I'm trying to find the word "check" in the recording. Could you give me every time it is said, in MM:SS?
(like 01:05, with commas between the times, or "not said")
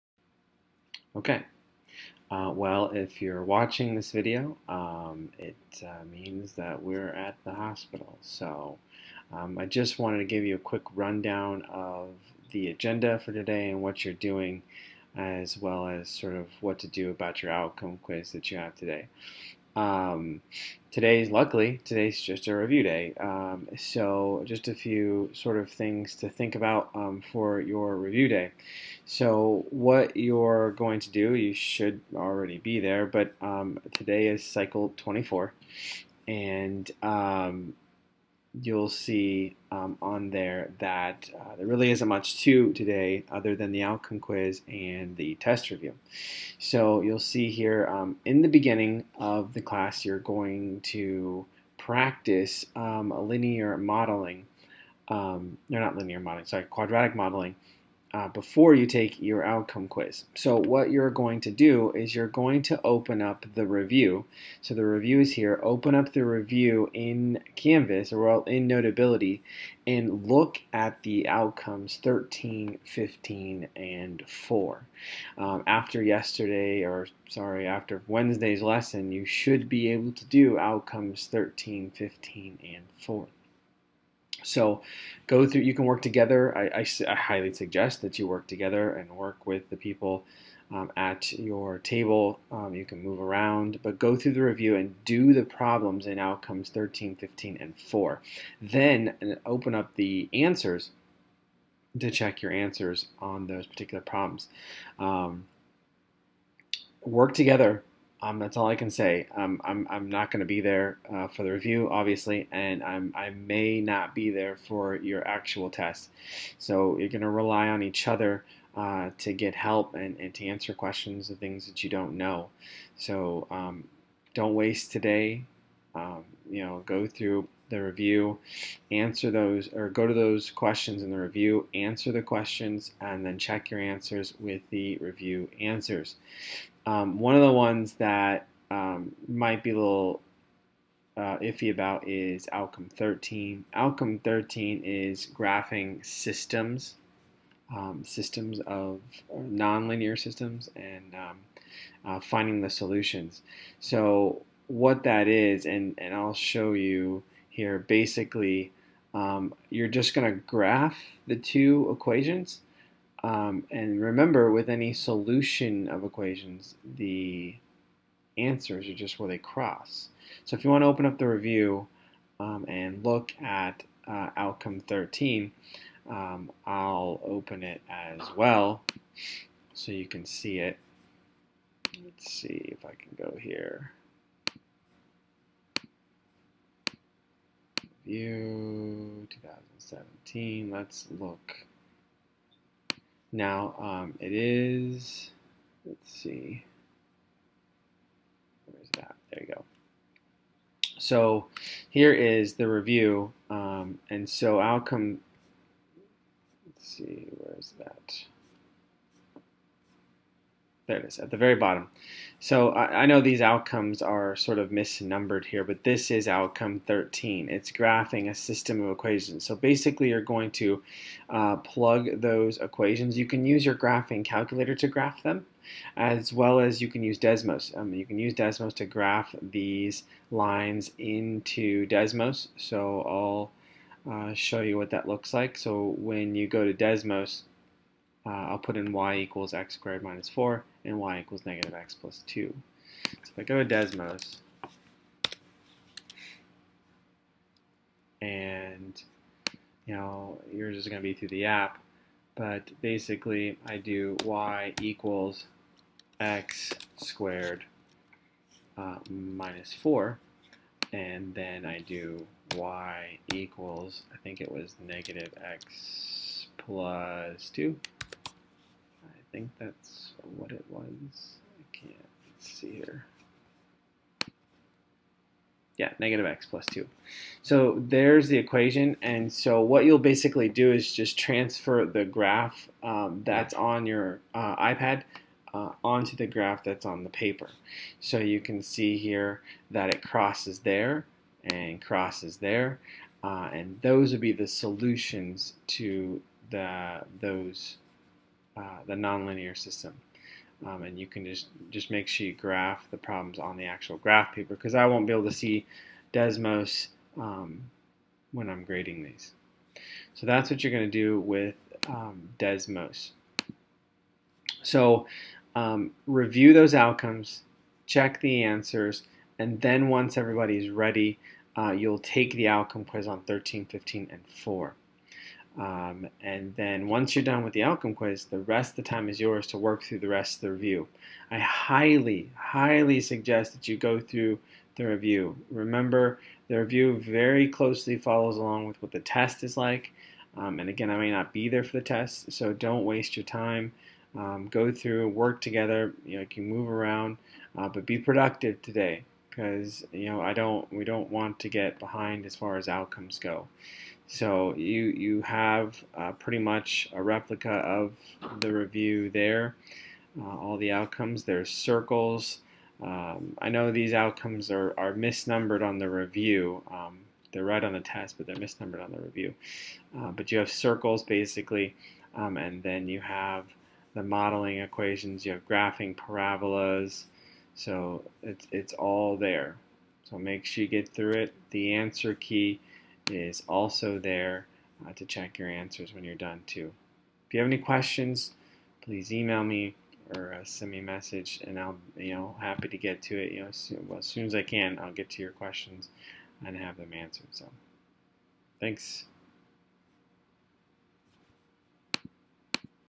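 01:42, 02:13, 05:17, 06:25.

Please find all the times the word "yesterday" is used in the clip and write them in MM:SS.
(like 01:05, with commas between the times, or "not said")
01:16.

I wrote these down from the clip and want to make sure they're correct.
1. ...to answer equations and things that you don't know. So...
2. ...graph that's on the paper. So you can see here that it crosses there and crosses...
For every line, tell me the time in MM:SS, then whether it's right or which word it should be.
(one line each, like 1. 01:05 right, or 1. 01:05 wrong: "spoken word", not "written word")
1. 02:00 wrong: "questions", not "equations"
2. 04:46 right.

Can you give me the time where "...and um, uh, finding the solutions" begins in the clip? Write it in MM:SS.
02:30.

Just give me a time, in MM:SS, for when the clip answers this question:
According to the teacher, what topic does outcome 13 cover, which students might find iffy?
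02:25.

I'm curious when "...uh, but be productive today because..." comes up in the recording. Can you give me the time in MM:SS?
05:47.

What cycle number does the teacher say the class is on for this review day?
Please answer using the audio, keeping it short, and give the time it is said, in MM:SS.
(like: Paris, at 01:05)
24, at 00:34.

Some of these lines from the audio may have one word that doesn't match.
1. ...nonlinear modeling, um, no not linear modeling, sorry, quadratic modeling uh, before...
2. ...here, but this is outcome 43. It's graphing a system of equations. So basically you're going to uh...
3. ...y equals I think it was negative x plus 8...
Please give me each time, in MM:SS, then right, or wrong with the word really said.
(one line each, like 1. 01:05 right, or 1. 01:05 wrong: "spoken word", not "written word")
1. 00:53 wrong: "linear", not "nonlinear"
2. 03:35 wrong: "13", not "43"
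3. 04:22 wrong: "2", not "8".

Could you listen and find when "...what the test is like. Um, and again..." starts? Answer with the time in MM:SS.
05:38.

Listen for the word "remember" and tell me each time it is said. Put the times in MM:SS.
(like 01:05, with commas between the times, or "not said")
02:44, 05:35.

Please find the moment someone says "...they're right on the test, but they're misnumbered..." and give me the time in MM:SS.
06:07.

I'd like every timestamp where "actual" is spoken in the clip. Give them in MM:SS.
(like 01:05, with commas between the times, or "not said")
01:55, 05:03.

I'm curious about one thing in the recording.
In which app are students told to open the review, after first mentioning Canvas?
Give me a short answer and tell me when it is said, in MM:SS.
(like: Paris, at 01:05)
Notability, at 01:08.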